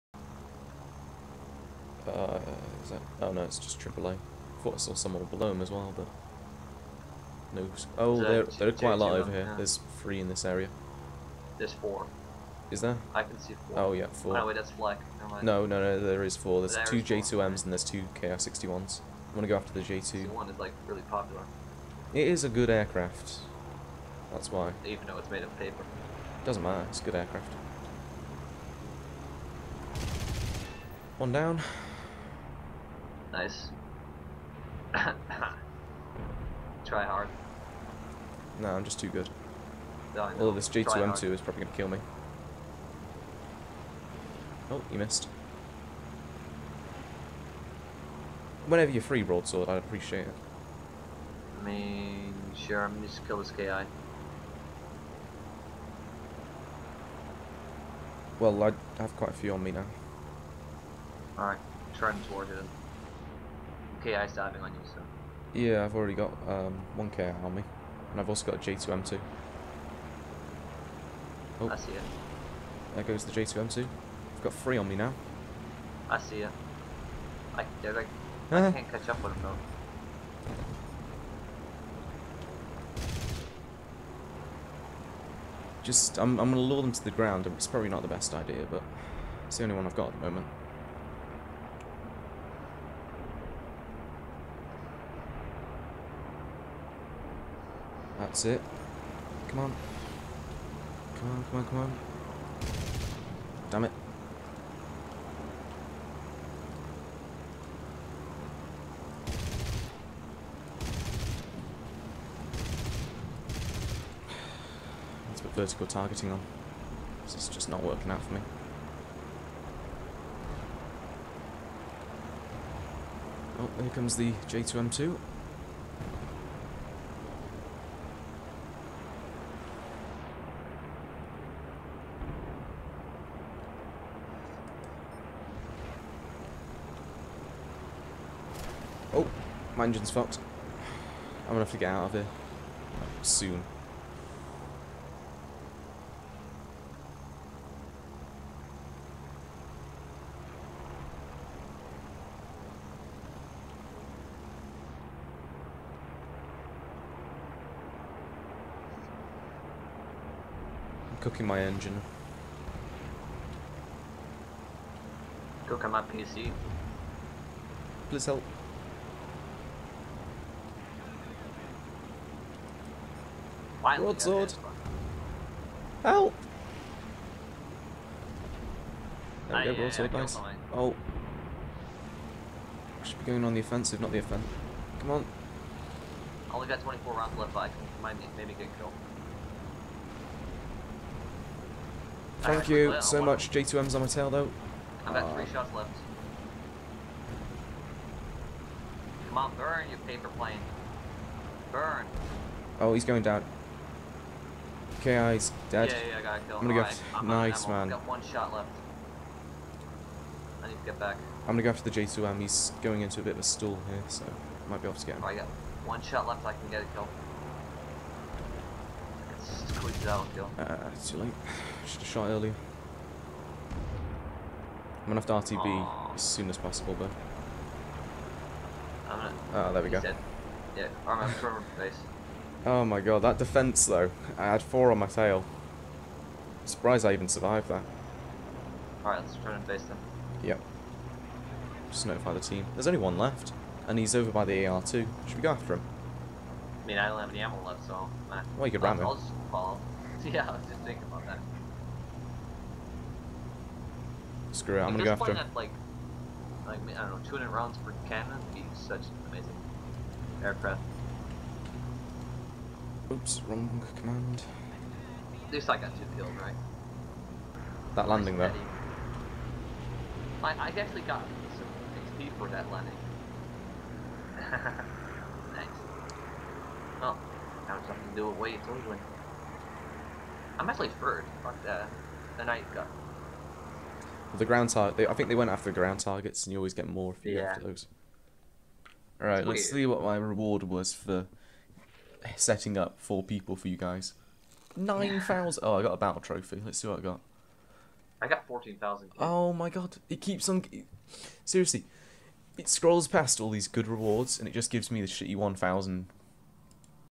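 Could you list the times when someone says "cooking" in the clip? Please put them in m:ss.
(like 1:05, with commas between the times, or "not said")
2:41, 2:45.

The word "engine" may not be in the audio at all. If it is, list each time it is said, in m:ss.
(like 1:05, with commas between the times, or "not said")
2:19, 2:41.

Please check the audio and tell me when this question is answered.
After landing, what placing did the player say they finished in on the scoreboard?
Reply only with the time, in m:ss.
4:41.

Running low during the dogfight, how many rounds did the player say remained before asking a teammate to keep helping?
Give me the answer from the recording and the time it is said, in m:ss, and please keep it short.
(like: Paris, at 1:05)
24, at 3:06.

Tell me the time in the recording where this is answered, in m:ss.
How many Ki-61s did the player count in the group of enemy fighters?
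0:17.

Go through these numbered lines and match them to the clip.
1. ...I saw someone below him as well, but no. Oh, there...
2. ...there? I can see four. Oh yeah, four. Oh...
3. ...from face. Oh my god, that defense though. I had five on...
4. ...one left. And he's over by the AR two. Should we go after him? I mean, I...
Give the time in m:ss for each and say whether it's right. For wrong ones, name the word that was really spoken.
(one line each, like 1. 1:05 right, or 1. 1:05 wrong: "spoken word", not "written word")
1. 0:04 right
2. 0:12 right
3. 3:51 wrong: "four", not "five"
4. 4:02 right.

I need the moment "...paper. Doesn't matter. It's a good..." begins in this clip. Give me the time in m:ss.
0:25.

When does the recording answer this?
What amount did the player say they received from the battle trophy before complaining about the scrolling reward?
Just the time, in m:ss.
4:58.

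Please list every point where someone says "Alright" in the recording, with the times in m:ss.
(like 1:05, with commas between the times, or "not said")
1:01, 3:59, 4:49.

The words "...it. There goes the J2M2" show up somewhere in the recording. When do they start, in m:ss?
1:11.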